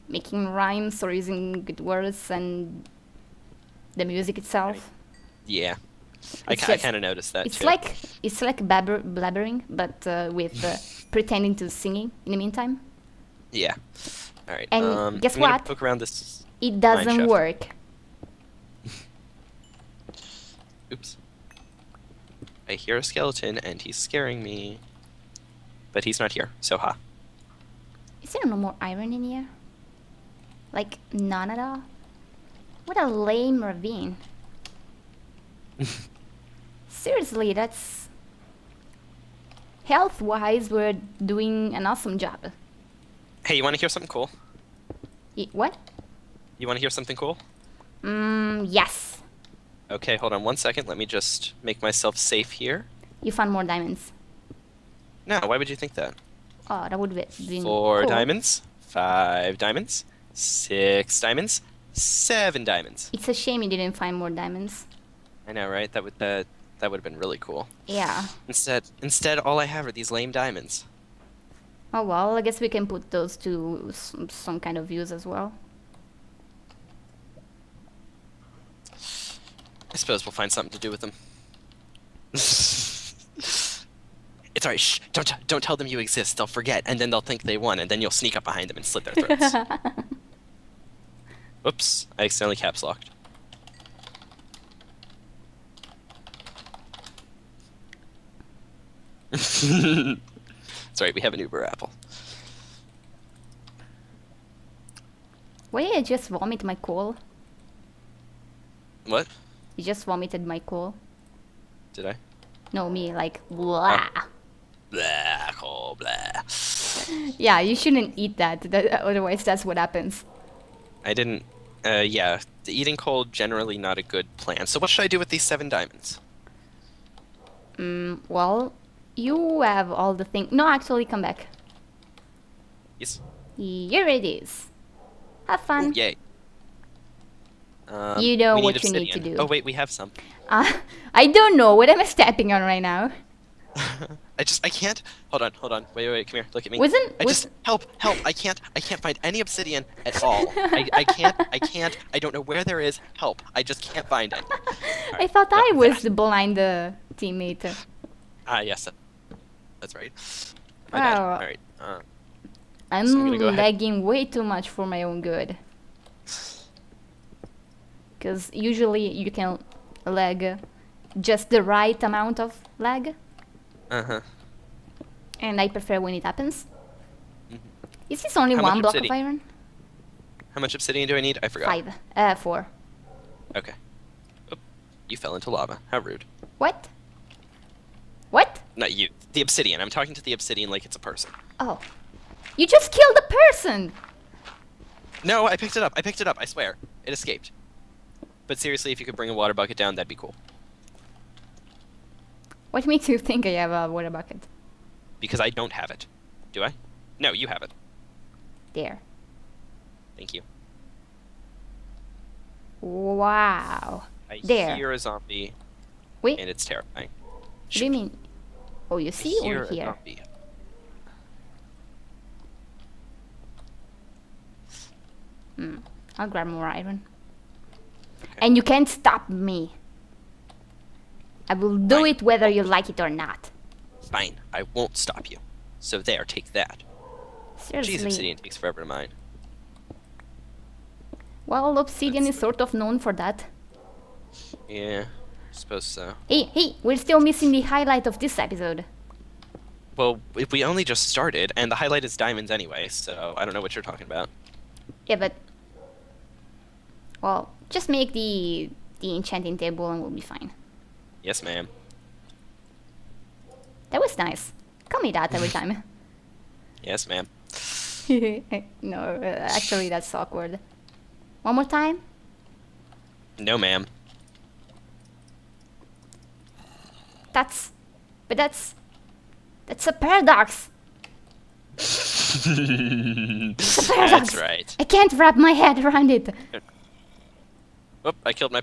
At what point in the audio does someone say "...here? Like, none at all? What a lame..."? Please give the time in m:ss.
0:29.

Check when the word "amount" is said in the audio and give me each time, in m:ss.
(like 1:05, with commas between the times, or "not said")
2:52.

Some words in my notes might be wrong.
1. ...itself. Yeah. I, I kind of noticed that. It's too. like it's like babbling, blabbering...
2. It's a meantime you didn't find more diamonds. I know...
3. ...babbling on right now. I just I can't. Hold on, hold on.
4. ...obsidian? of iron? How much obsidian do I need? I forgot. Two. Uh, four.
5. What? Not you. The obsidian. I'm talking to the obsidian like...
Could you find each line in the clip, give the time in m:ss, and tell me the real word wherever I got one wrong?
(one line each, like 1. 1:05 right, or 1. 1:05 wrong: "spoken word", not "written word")
1. 0:04 right
2. 1:03 wrong: "shame", not "meantime"
3. 2:22 wrong: "stepping", not "babbling"
4. 2:58 wrong: "Five", not "Two"
5. 3:08 right.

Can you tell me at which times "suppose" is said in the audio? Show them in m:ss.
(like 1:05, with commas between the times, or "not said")
1:19, 4:05.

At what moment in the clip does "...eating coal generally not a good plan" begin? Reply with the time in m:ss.
2:02.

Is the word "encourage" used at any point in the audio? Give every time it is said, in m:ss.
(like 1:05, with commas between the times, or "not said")
not said.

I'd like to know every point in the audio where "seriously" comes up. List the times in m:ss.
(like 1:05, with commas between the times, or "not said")
0:36, 3:18, 3:57.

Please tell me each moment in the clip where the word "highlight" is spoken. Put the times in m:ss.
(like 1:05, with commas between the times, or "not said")
4:07, 4:11.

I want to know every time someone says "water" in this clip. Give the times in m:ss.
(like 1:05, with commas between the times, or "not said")
3:19, 3:23.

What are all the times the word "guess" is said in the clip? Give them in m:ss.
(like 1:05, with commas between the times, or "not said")
0:15, 1:12.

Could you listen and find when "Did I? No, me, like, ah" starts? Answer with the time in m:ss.
1:51.